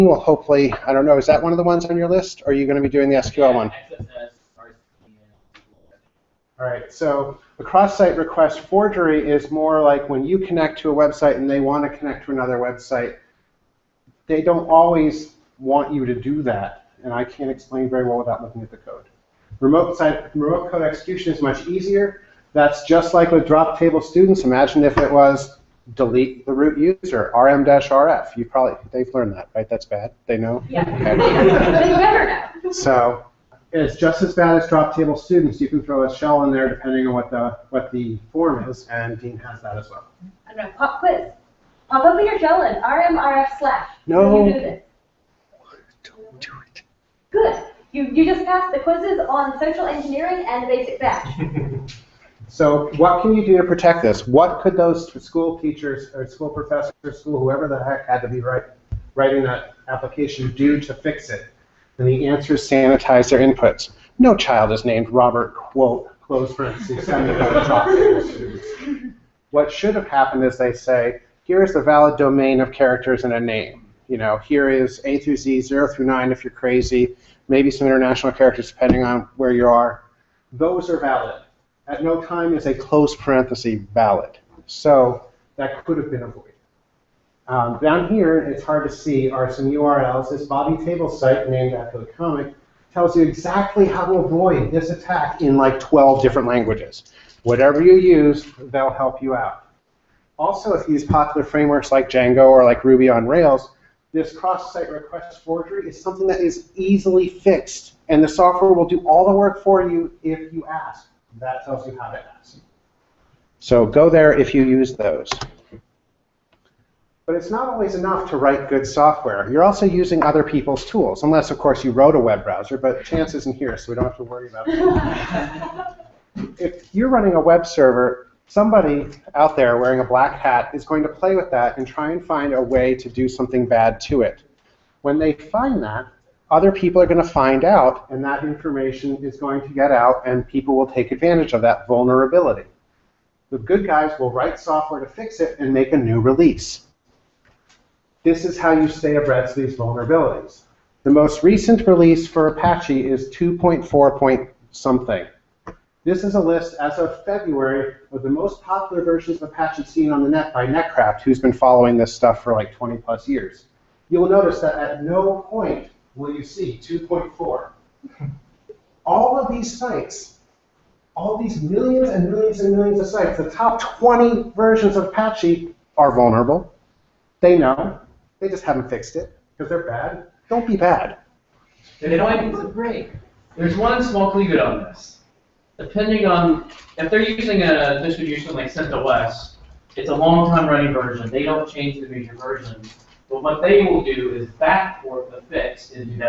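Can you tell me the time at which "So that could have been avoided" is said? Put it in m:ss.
1:24.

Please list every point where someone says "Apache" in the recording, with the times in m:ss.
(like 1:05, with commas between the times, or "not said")
2:32, 2:39, 2:55.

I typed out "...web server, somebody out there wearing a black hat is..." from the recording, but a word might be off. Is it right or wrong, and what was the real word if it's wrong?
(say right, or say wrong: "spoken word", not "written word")
right.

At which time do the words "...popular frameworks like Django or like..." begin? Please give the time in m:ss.
1:41.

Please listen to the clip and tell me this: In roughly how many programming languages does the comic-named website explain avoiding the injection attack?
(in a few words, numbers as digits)
12.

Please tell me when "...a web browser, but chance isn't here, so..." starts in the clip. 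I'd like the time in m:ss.
2:02.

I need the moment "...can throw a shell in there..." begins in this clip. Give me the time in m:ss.
0:35.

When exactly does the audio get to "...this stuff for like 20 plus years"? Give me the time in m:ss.
2:41.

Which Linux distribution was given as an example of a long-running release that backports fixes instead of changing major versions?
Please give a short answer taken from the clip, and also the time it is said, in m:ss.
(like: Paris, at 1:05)
CentOS, at 3:08.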